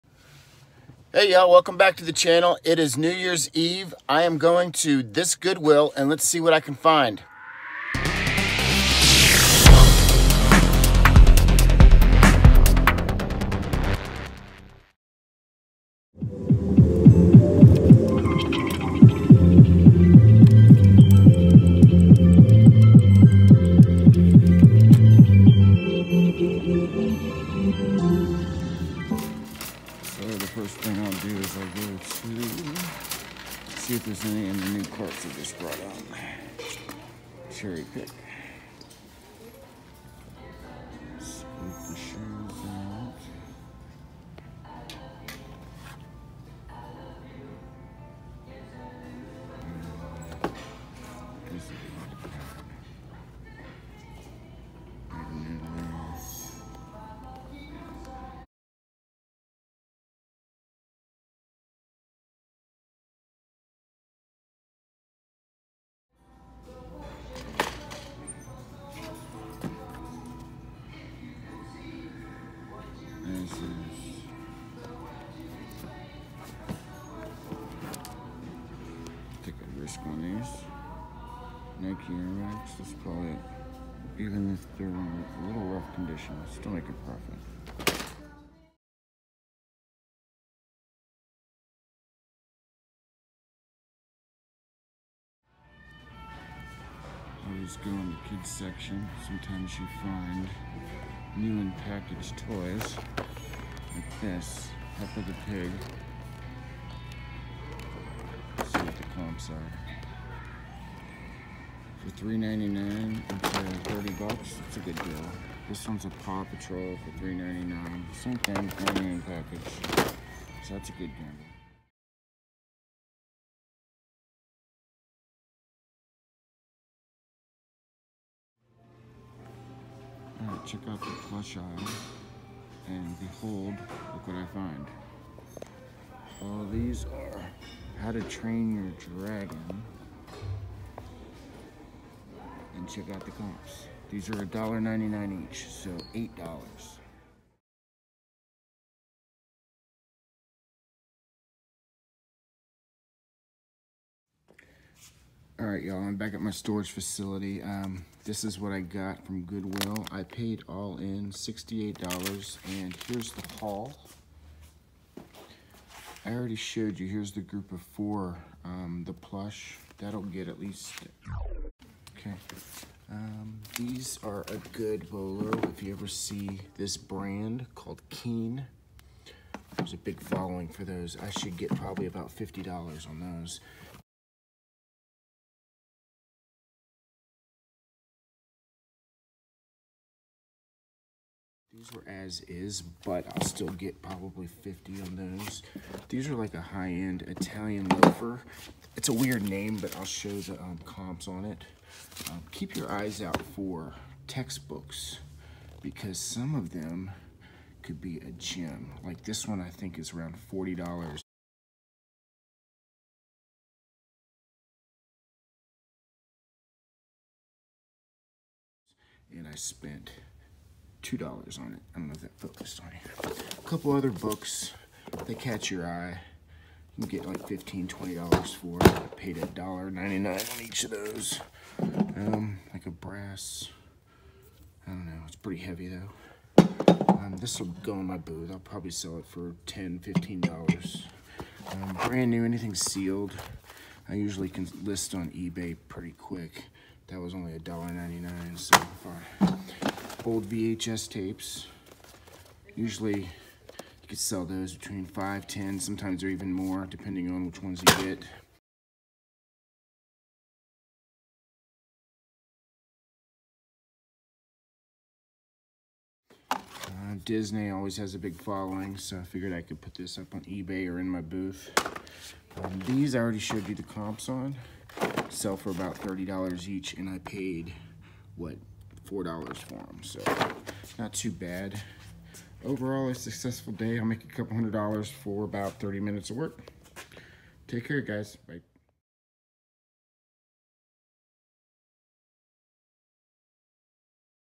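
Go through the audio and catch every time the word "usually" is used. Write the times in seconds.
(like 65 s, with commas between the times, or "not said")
244 s, 252 s.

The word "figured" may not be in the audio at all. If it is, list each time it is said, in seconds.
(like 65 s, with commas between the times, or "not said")
269 s.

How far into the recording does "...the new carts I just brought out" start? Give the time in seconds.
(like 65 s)
34 s.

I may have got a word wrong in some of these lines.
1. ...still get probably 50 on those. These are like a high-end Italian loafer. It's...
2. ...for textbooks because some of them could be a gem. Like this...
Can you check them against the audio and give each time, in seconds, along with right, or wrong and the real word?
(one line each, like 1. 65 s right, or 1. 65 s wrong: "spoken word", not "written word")
1. 193 s right
2. 203 s right.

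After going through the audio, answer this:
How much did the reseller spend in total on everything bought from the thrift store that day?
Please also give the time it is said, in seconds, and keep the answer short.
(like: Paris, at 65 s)
$68, at 161 s.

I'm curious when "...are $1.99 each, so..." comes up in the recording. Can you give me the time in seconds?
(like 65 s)
144 s.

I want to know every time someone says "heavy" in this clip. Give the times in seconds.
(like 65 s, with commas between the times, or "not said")
235 s.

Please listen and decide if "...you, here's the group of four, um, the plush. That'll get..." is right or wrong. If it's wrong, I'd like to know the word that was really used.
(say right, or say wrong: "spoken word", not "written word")
right.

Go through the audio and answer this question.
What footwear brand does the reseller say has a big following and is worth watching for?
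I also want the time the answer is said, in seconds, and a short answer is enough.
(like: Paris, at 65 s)
Keen, at 178 s.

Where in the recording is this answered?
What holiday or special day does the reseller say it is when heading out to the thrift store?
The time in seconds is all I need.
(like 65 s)
2 s.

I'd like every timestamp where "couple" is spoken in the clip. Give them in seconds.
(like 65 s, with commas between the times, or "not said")
223 s, 284 s.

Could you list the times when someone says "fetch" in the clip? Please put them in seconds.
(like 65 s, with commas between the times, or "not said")
not said.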